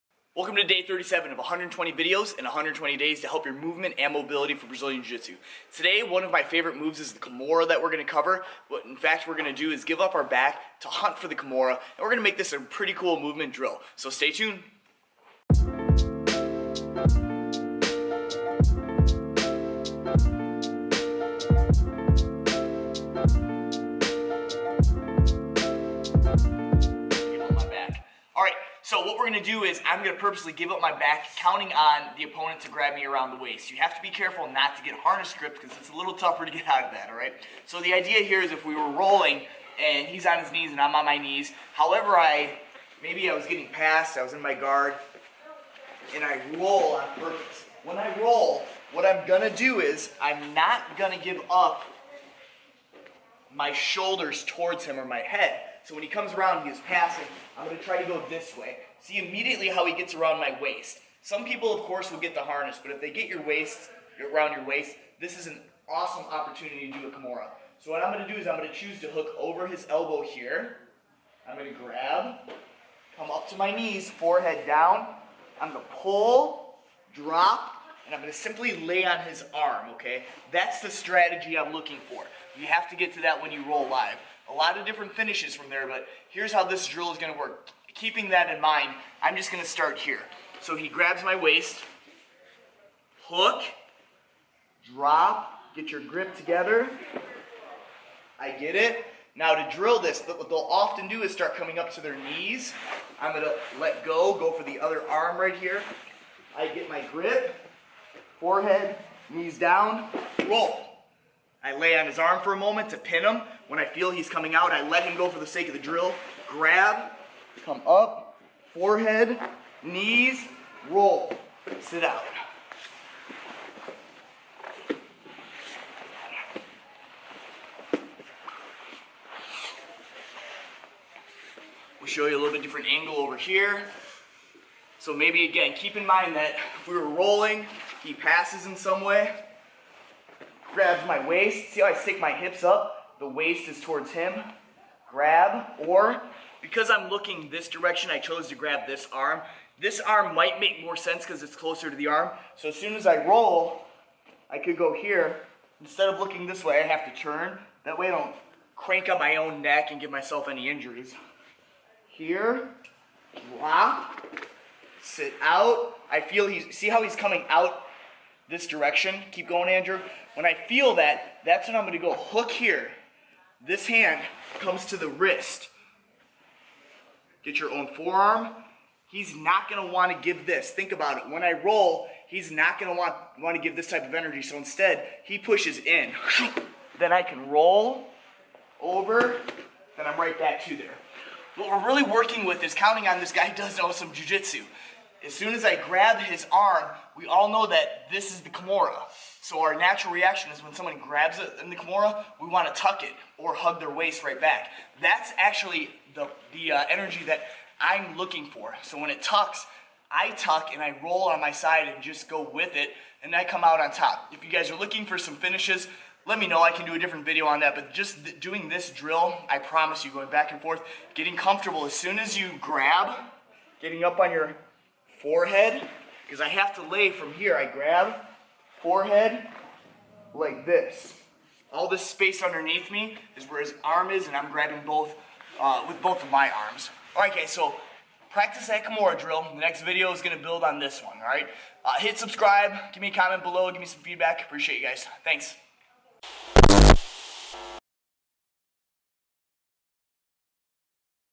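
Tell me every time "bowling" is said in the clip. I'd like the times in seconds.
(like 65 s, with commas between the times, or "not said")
not said.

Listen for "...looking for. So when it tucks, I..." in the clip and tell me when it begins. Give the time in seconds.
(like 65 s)
208 s.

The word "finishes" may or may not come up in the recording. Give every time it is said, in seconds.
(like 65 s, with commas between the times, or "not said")
85 s, 215 s.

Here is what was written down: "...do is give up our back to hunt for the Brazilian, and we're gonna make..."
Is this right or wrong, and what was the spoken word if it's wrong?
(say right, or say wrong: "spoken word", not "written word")
wrong: "Kimura", not "Brazilian".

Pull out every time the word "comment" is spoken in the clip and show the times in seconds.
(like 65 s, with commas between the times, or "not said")
243 s.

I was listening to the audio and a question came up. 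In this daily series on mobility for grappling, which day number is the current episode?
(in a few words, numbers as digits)
37.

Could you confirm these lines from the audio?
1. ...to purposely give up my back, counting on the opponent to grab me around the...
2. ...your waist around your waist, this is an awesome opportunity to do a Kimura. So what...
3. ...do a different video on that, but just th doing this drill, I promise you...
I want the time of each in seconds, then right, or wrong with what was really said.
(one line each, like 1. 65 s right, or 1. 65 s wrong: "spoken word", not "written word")
1. 30 s right
2. 63 s right
3. 216 s right.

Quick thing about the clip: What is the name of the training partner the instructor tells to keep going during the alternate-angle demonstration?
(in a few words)
Andrew.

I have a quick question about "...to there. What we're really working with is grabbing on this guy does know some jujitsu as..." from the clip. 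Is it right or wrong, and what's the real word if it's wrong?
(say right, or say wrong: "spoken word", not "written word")
wrong: "counting", not "grabbing".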